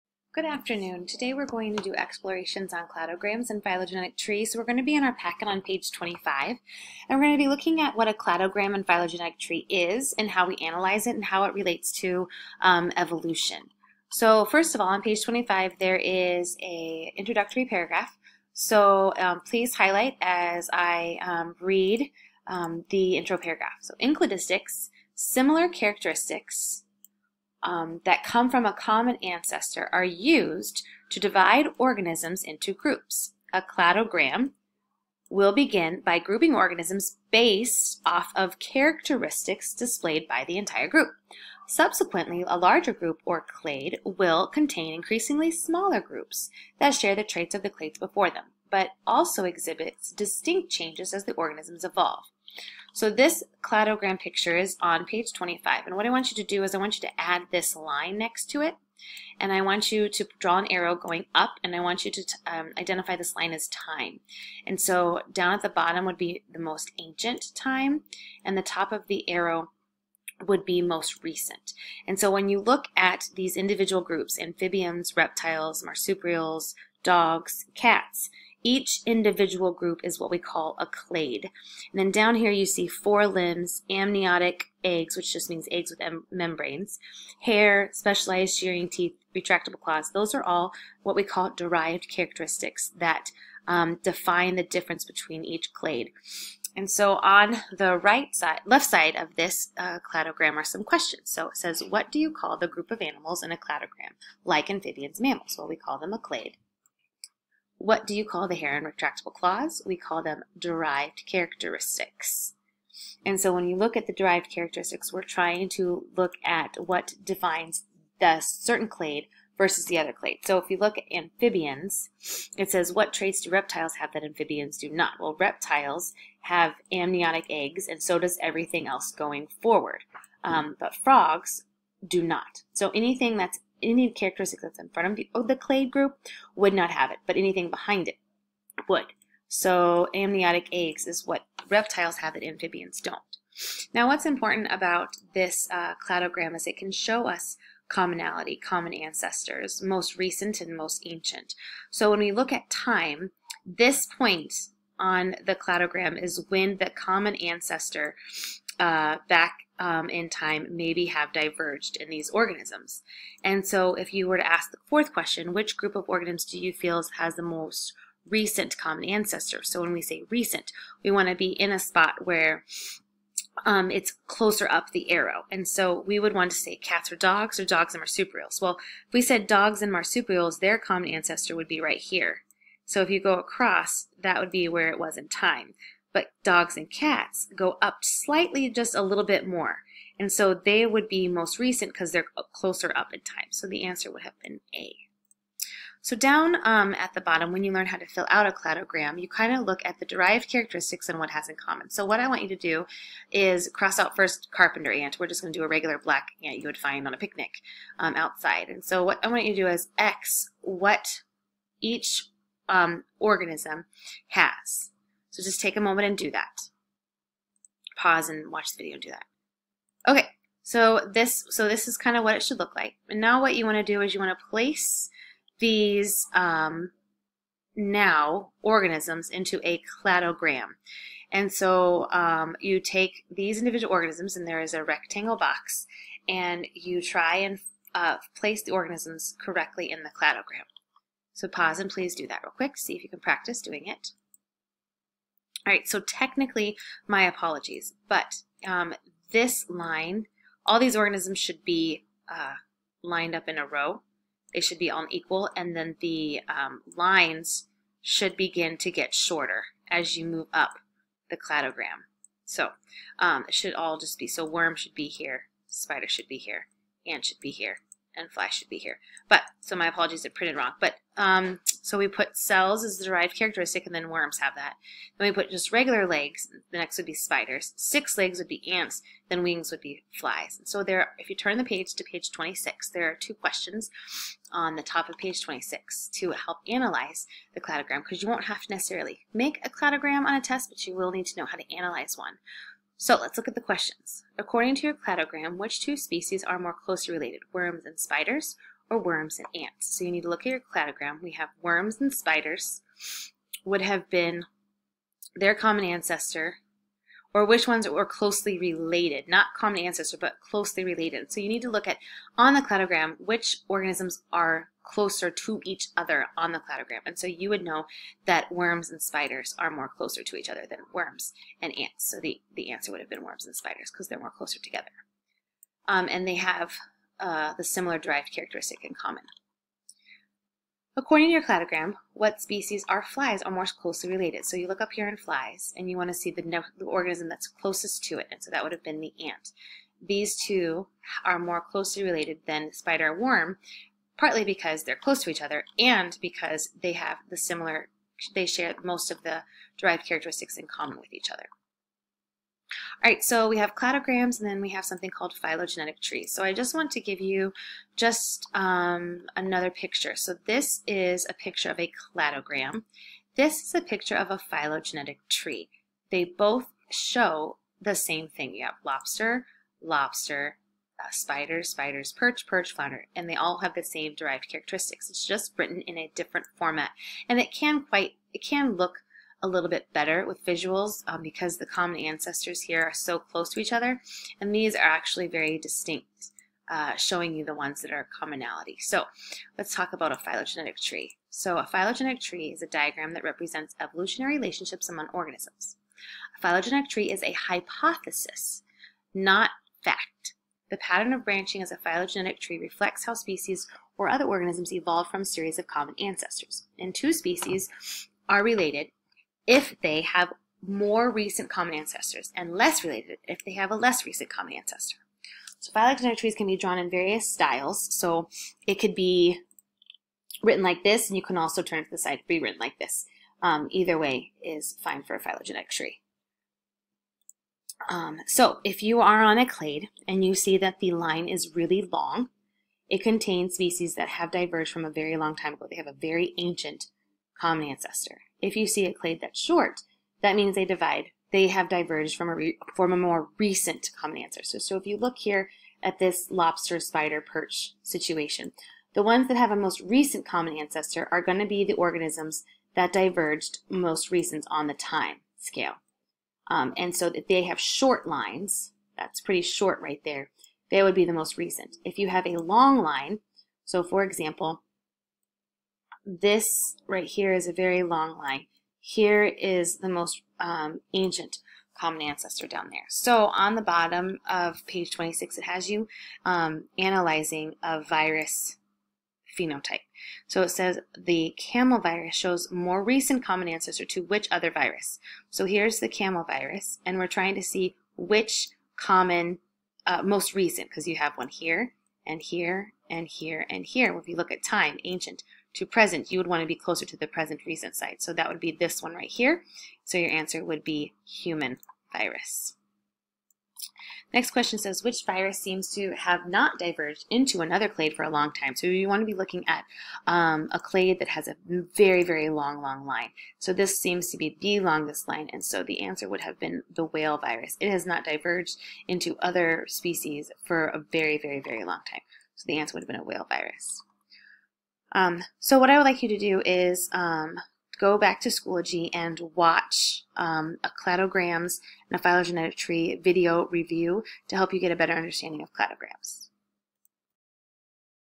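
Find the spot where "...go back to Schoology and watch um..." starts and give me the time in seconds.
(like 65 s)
527 s.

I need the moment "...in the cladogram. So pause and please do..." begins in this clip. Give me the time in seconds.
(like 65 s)
239 s.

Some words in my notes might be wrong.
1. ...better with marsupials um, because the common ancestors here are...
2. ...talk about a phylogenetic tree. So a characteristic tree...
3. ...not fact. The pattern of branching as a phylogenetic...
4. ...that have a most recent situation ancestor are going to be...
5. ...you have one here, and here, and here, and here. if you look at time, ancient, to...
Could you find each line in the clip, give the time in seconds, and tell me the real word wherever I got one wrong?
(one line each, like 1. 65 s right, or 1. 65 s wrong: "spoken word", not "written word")
1. 379 s wrong: "visuals", not "marsupials"
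2. 389 s wrong: "phylogenetic", not "characteristic"
3. 399 s right
4. 449 s wrong: "common", not "situation"
5. 490 s right.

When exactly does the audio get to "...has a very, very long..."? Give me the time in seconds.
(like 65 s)
511 s.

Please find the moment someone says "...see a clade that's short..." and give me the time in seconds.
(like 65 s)
438 s.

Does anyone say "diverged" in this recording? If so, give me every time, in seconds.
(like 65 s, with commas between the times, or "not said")
161 s, 434 s, 441 s, 452 s, 506 s, 518 s.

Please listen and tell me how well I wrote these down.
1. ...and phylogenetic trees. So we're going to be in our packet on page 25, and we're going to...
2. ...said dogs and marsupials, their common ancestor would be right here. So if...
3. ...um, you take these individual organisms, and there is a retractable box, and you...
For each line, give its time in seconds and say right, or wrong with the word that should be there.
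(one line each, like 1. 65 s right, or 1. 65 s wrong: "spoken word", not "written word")
1. 3 s right
2. 179 s right
3. 232 s wrong: "rectangle", not "retractable".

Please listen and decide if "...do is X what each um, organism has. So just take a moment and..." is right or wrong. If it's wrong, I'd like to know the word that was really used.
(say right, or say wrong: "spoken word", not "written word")
right.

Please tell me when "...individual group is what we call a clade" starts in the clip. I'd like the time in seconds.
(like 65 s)
79 s.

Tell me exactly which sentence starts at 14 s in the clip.
So first of all, on page 25, there is a introductory paragraph.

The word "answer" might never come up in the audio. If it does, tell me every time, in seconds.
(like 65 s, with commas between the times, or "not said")
193 s, 322 s, 500 s, 515 s, 522 s.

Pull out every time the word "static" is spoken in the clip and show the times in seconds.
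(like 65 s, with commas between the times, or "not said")
not said.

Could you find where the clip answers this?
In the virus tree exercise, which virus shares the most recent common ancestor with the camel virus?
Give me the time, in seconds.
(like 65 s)
501 s.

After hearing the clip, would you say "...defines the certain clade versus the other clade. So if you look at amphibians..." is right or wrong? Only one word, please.
right.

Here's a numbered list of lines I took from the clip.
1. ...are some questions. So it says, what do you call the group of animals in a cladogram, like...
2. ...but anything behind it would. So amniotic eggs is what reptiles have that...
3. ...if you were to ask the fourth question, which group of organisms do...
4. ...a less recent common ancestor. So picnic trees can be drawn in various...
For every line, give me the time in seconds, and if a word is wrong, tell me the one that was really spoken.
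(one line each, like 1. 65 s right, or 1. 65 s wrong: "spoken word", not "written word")
1. 100 s right
2. 137 s right
3. 163 s right
4. 413 s wrong: "phylogenetic", not "picnic".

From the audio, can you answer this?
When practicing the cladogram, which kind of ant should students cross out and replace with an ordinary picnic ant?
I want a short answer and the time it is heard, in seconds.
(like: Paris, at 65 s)
carpenter ant, at 204 s.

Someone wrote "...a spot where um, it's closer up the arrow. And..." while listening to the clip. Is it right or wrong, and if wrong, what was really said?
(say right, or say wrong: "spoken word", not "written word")
right.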